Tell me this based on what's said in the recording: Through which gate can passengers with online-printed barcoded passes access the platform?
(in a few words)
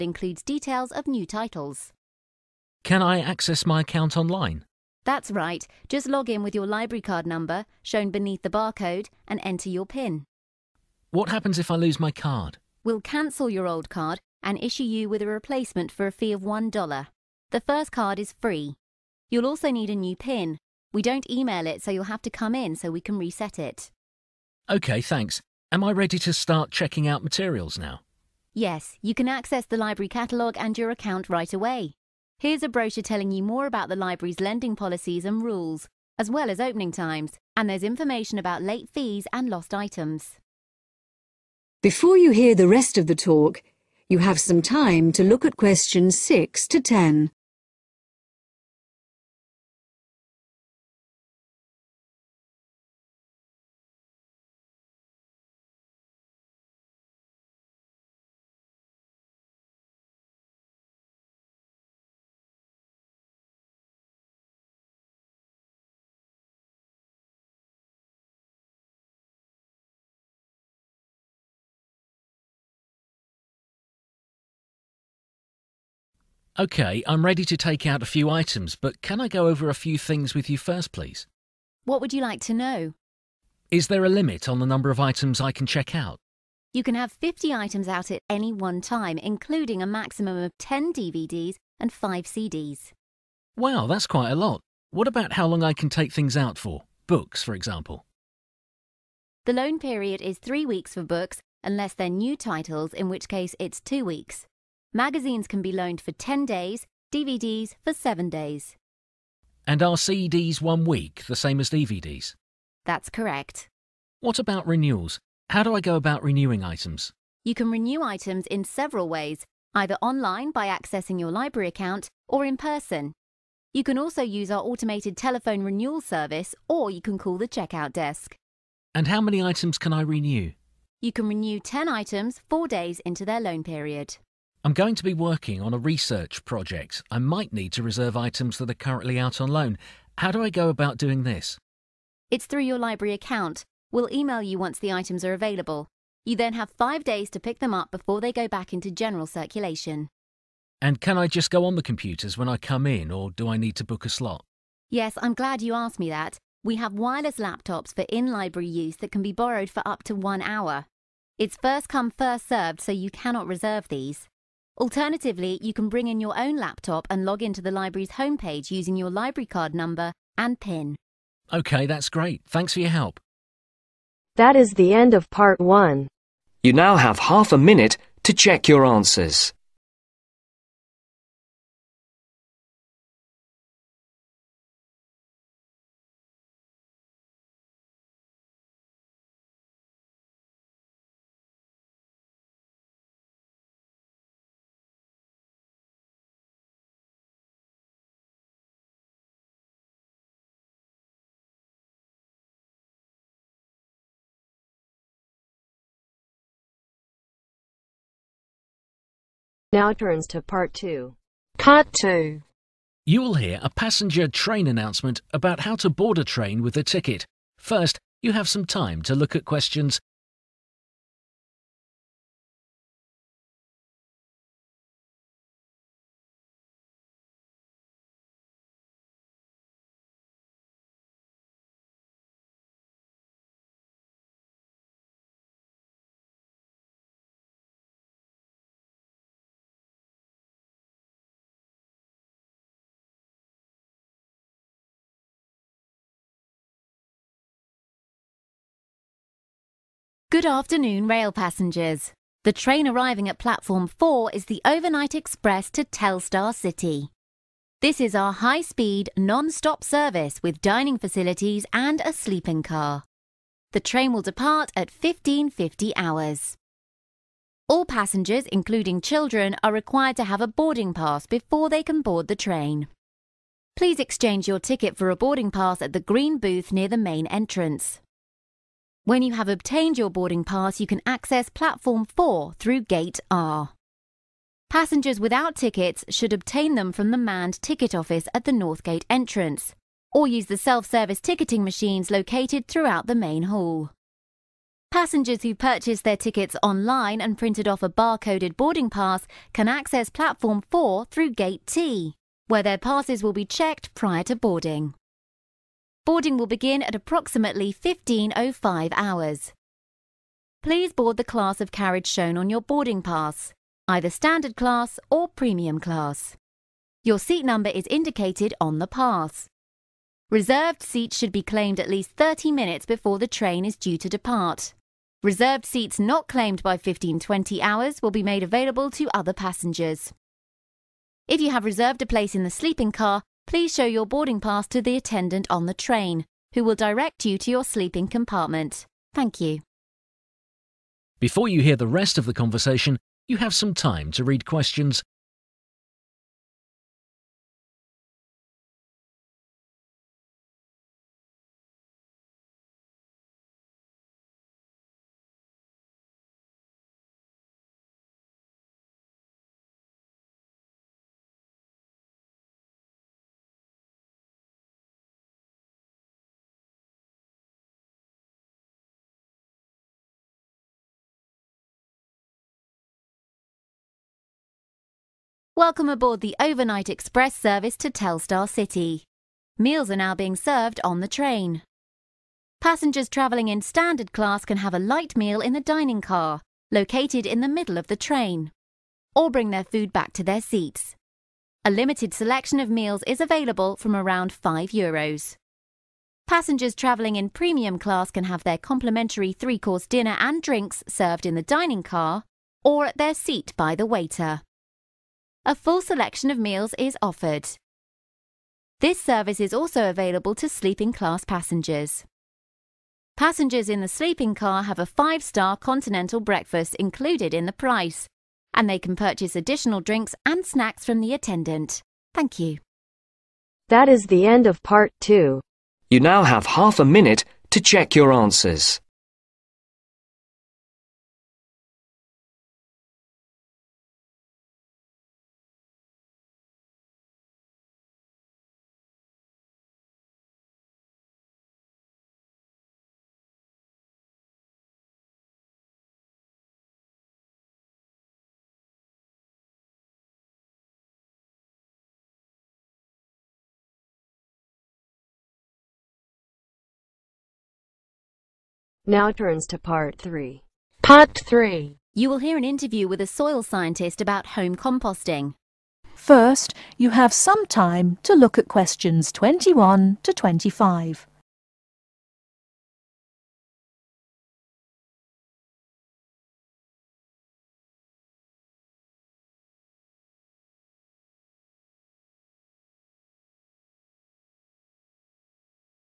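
Gate T.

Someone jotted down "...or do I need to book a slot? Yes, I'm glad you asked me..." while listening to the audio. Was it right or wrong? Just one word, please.
right.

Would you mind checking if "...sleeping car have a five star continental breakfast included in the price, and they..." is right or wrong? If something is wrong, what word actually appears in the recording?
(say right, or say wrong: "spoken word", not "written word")
right.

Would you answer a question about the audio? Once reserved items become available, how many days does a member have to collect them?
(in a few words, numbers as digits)
5 days.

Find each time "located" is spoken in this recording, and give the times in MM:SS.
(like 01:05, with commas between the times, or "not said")
04:52, 06:26.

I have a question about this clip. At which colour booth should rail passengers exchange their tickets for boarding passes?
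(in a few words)
green.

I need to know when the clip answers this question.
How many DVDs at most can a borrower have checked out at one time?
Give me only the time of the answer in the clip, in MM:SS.
01:30.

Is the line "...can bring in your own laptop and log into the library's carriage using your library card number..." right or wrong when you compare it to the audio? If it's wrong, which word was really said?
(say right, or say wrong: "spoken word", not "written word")
wrong: "homepage", not "carriage".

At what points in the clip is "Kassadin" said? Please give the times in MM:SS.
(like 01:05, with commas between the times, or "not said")
not said.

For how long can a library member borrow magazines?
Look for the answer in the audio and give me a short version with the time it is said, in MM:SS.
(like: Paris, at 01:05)
10 days, at 01:46.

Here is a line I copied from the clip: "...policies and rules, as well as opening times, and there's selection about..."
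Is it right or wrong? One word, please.
wrong.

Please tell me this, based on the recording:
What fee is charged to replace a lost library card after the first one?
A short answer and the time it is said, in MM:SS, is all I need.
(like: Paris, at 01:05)
$1, at 00:16.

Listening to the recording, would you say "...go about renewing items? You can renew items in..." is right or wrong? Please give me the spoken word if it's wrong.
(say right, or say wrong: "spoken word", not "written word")
right.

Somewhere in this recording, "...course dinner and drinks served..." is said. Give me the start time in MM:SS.
06:39.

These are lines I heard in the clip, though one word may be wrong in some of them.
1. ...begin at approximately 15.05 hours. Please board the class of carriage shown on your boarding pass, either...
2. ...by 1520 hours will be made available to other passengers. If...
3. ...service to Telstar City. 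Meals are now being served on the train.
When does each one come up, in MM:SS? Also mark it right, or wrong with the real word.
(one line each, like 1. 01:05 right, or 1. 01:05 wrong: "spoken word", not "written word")
1. 05:06 right
2. 05:26 right
3. 06:17 right.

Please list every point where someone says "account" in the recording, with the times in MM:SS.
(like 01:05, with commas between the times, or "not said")
00:03, 00:30, 02:01, 02:23.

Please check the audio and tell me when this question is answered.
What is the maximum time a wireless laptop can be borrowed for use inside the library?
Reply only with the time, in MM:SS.
02:40.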